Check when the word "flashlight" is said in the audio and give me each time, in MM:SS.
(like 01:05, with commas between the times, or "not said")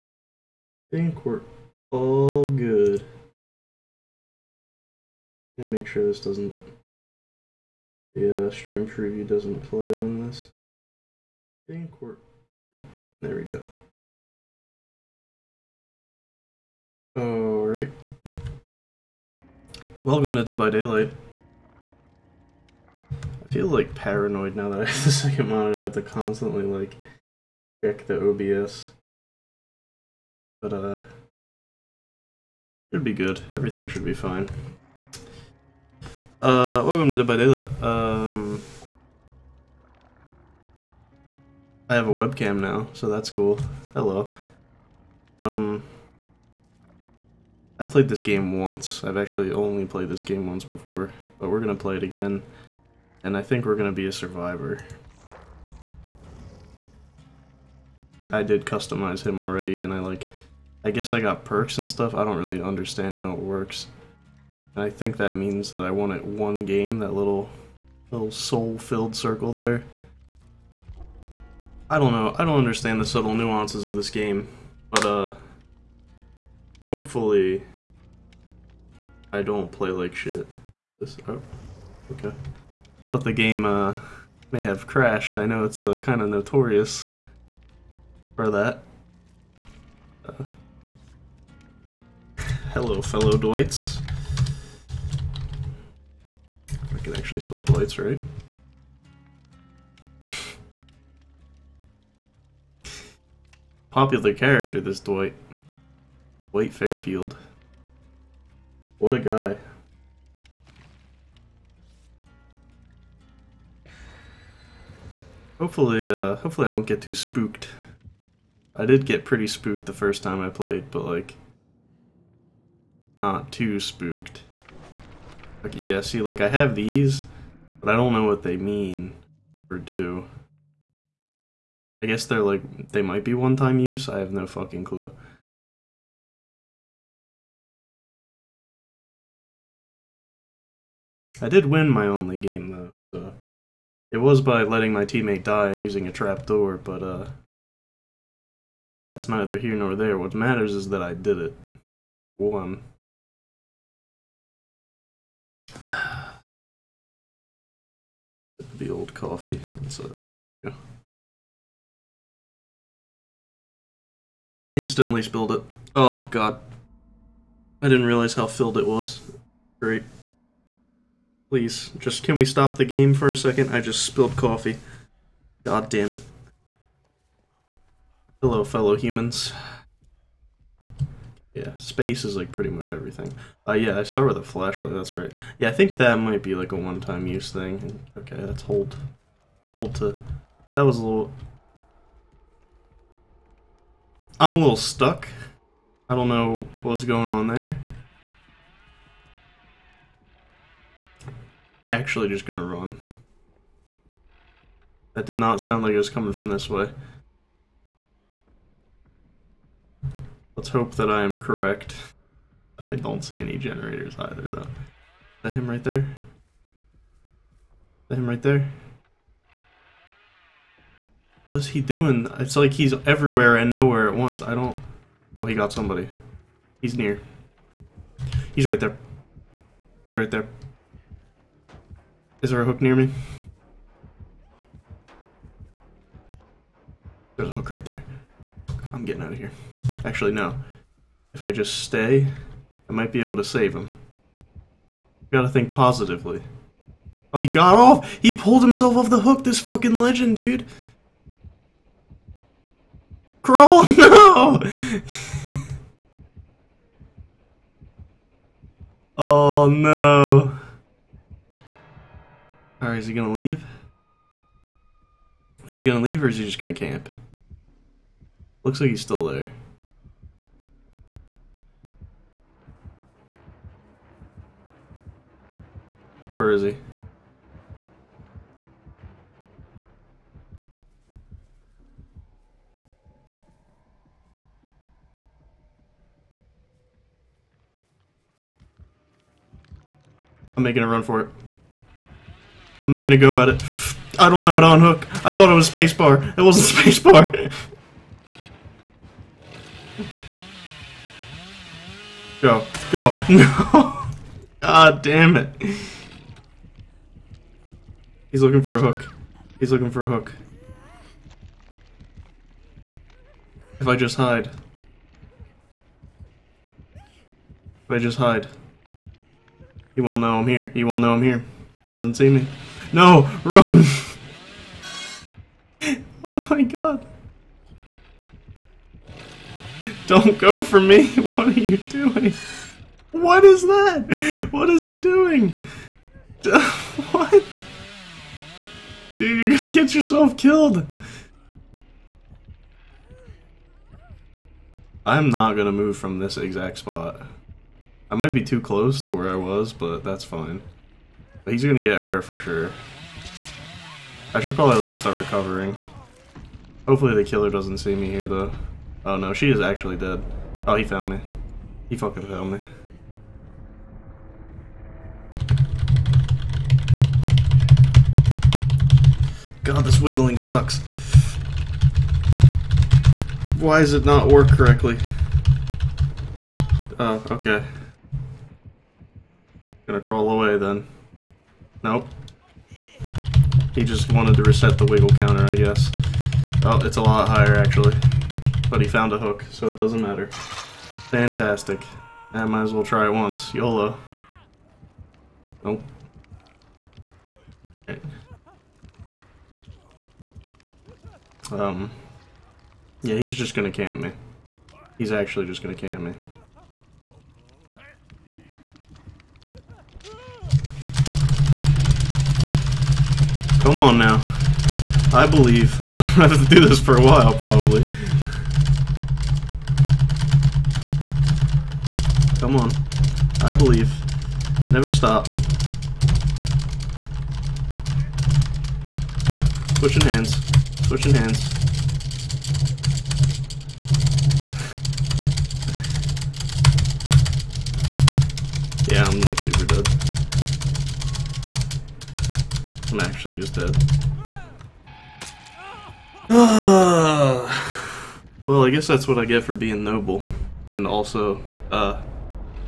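03:04.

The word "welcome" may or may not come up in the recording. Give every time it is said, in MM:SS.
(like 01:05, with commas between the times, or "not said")
00:20, 00:36.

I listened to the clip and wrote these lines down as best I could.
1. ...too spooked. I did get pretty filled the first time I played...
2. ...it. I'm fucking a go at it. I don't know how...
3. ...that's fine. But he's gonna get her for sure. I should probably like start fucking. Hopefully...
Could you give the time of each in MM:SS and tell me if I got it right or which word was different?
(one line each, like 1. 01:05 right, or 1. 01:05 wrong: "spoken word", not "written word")
1. 01:57 wrong: "spooked", not "filled"
2. 04:51 wrong: "making", not "fucking"
3. 05:50 wrong: "recovering", not "fucking".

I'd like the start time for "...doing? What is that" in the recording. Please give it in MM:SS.
05:31.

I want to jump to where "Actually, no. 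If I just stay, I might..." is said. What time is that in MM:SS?
04:00.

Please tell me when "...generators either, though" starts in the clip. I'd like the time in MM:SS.
03:33.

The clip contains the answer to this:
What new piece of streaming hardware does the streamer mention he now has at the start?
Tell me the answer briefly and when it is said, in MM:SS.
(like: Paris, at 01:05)
a webcam, at 00:42.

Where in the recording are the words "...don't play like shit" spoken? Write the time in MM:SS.
01:19.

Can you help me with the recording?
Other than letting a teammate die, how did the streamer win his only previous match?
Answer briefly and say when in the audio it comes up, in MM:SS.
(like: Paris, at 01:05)
using a trapdoor, at 02:25.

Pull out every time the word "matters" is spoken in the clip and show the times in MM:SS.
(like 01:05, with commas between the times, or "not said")
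02:30, 06:30.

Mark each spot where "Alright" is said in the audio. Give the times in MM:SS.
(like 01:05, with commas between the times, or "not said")
00:17, 04:22.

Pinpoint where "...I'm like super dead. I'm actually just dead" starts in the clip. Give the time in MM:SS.
07:19.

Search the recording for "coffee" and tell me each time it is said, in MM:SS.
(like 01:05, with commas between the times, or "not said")
02:39, 02:54.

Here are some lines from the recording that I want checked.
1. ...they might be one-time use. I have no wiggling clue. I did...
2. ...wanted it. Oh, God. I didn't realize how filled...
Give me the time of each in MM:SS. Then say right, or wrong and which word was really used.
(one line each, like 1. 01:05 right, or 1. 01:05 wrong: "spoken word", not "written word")
1. 02:12 wrong: "fucking", not "wiggling"
2. 02:45 wrong: "spilled", not "wanted".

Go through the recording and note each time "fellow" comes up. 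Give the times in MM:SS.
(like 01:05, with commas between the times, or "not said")
01:33, 02:58.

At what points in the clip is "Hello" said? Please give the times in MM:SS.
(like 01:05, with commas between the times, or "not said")
00:43, 01:32, 02:58.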